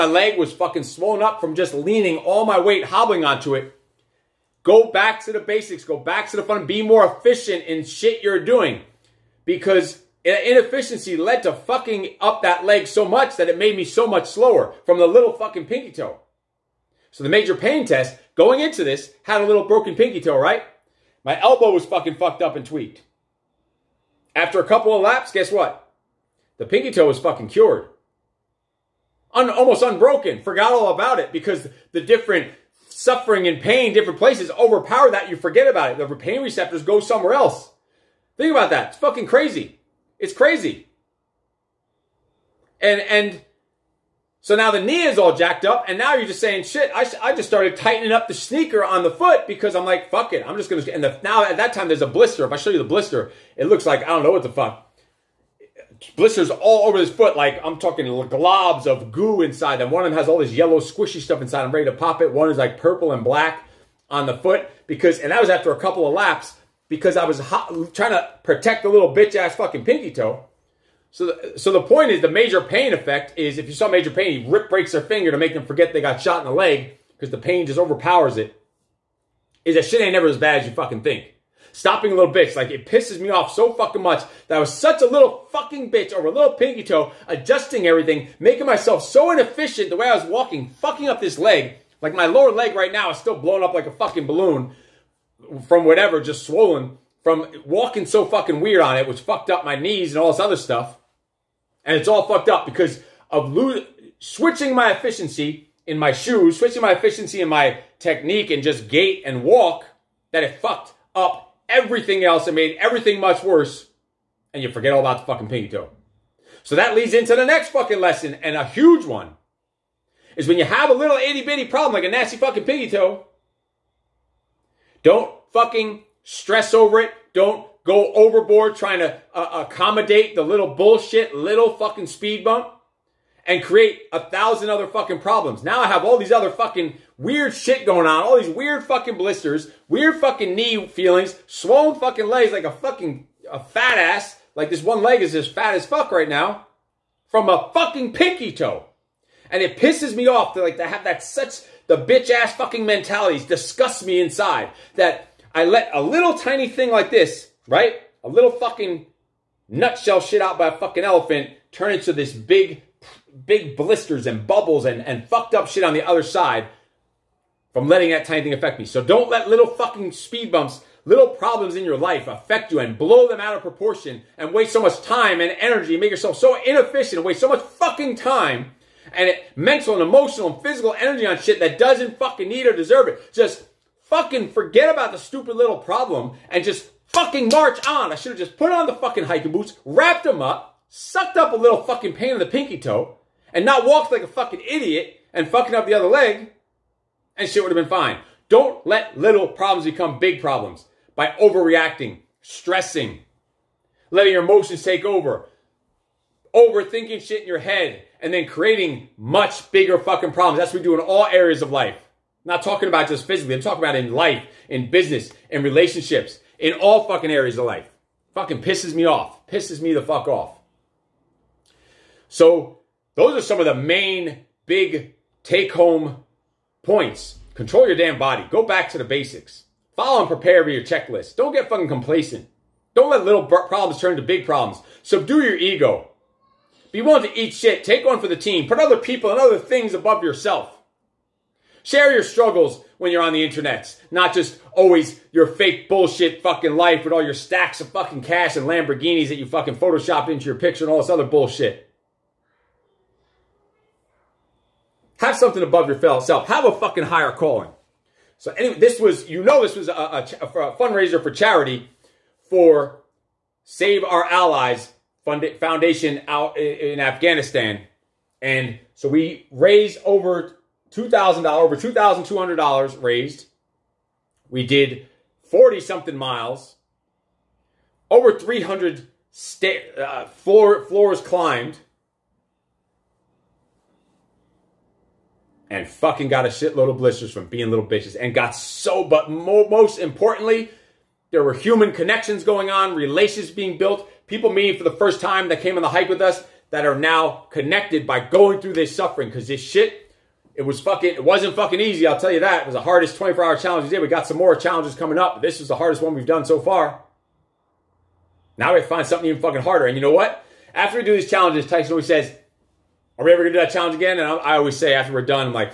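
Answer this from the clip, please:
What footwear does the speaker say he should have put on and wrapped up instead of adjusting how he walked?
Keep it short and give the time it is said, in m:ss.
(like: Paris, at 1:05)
hiking boots, at 3:09.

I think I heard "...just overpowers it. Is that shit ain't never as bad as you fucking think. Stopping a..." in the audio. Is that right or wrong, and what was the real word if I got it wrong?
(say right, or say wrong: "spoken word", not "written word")
right.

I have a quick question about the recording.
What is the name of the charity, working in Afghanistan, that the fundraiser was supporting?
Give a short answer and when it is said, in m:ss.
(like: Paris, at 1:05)
Save Our Allies Foundation, at 4:23.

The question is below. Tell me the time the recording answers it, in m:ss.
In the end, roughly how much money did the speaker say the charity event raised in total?
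4:31.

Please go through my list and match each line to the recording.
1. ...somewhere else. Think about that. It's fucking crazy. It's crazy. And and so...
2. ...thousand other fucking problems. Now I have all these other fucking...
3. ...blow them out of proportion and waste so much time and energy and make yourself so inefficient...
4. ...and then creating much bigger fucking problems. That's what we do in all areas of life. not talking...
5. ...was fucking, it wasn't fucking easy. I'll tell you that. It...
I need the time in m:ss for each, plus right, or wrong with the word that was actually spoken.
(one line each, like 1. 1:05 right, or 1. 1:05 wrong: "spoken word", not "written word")
1. 0:36 right
2. 2:14 right
3. 2:52 right
4. 3:28 right
5. 5:00 right.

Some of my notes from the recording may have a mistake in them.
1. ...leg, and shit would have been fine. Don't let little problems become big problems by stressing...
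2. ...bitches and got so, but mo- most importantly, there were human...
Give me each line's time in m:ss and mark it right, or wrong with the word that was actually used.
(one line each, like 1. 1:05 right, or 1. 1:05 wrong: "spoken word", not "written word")
1. 3:16 wrong: "overreacting", not "stressing"
2. 4:47 right.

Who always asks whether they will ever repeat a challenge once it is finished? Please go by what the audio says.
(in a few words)
Tyson.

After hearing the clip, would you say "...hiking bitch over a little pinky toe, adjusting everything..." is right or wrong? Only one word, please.
wrong.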